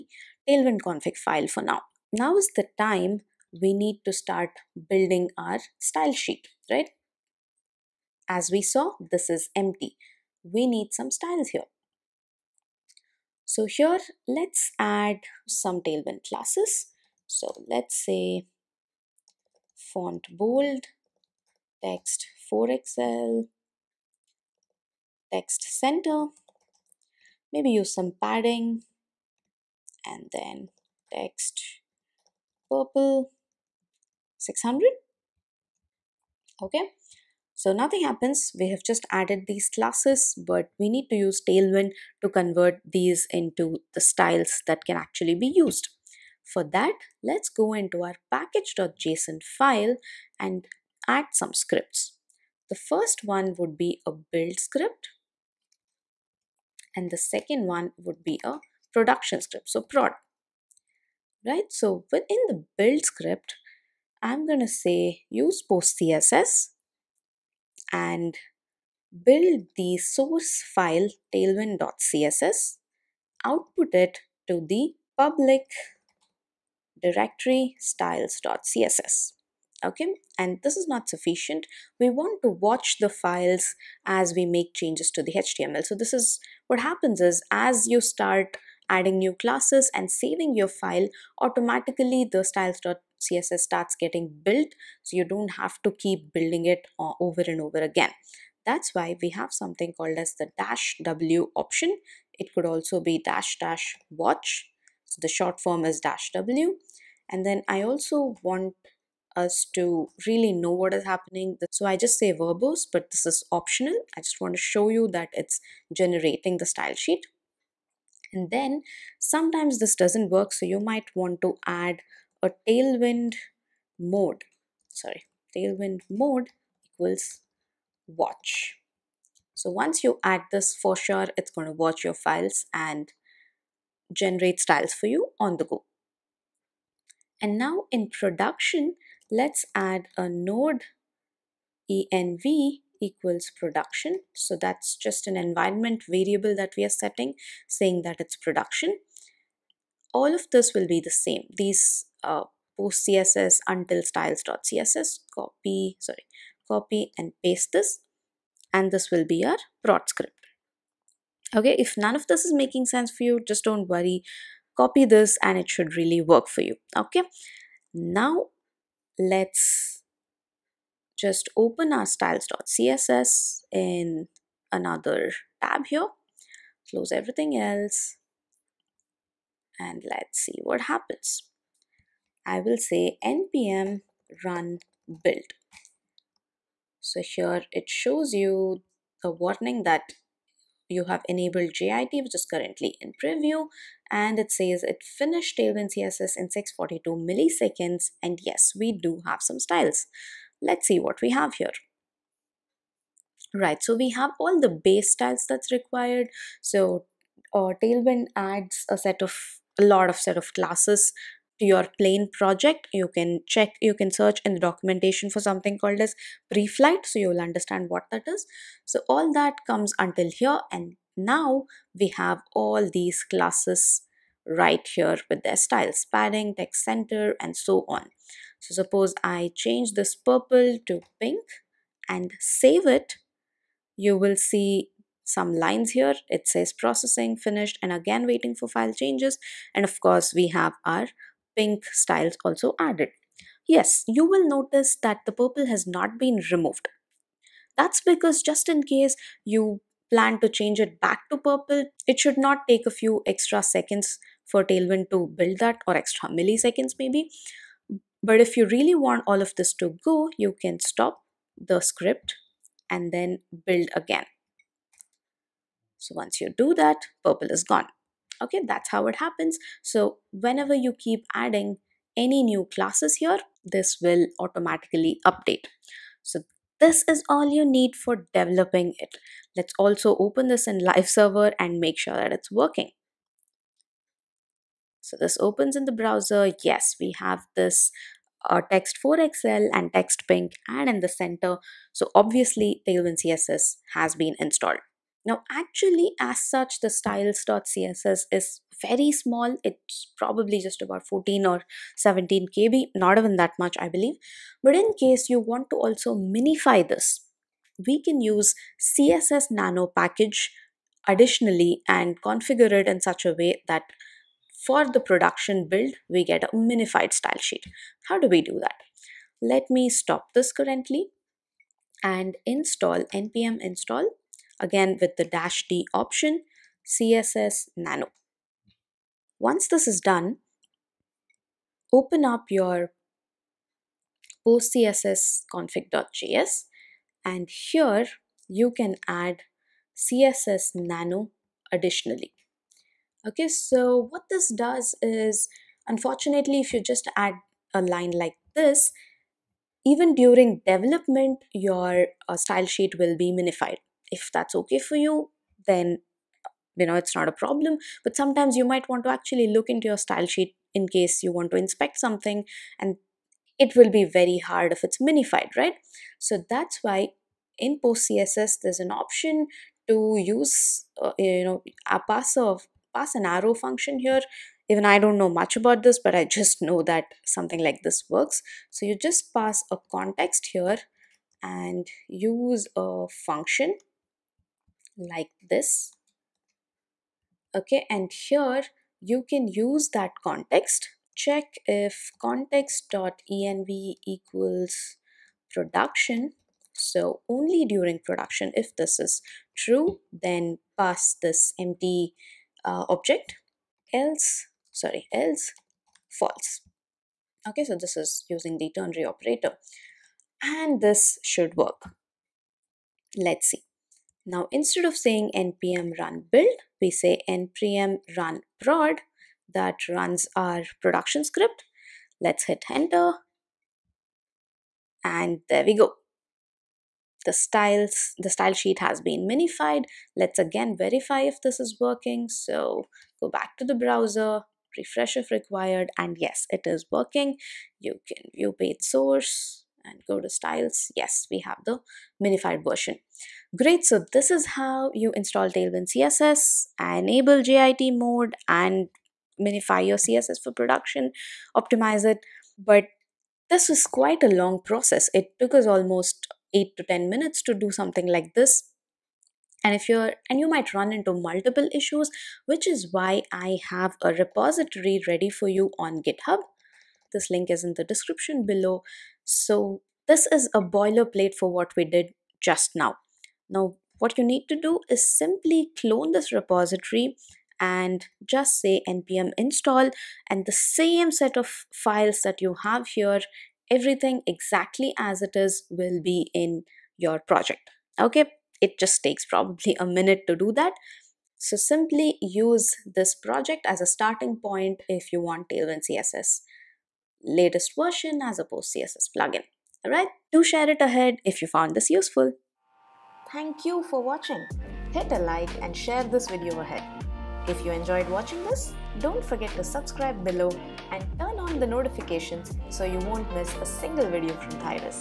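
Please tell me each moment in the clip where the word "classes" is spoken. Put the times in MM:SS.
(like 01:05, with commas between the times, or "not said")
00:16, 00:39, 01:29, 03:30, 03:43, 04:32.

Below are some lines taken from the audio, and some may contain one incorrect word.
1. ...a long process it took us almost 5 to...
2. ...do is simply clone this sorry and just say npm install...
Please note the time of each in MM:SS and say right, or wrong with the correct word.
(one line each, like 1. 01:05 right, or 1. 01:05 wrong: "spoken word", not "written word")
1. 07:34 wrong: "8", not "5"
2. 07:54 wrong: "repository", not "sorry".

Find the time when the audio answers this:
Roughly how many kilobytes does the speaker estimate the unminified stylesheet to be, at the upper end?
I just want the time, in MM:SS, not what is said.
05:01.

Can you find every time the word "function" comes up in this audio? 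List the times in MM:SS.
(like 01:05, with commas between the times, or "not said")
06:13, 06:23.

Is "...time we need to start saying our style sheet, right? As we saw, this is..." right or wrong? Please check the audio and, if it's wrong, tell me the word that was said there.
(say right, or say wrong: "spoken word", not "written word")
wrong: "building", not "saying".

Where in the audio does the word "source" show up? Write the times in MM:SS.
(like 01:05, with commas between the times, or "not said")
01:09, 07:18.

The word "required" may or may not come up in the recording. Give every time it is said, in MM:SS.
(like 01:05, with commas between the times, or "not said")
03:25, 07:15.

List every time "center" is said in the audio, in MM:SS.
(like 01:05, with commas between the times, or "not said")
00:25, 03:46, 04:51.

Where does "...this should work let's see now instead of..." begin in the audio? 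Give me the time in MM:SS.
06:50.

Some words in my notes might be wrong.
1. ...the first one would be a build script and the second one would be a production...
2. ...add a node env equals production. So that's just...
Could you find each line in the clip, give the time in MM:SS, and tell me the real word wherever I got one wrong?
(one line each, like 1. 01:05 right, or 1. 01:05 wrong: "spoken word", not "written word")
1. 00:52 right
2. 02:19 right.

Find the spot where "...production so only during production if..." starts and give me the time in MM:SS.
06:35.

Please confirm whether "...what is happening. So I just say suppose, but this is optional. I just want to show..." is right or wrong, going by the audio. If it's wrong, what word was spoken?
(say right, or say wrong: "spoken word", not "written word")
wrong: "verbose", not "suppose".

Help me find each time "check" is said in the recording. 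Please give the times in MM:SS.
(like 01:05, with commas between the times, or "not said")
03:33, 06:31.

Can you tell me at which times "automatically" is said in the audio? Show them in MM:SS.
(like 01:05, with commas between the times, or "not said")
01:31, 04:34.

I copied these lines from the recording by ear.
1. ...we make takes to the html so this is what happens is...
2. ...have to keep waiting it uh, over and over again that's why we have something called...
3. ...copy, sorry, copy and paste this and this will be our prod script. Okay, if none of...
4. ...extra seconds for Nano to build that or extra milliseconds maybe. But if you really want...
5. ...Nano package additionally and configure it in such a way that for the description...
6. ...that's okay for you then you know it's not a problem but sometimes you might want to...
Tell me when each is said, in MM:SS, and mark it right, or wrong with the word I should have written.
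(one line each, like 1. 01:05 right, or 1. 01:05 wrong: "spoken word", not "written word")
1. 01:24 wrong: "changes", not "takes"
2. 01:35 wrong: "building", not "waiting"
3. 02:35 right
4. 04:13 wrong: "Tailwind", not "Nano"
5. 05:09 wrong: "production", not "description"
6. 05:54 right.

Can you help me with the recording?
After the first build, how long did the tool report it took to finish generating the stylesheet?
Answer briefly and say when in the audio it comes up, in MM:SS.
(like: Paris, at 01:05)
642 milliseconds, at 03:16.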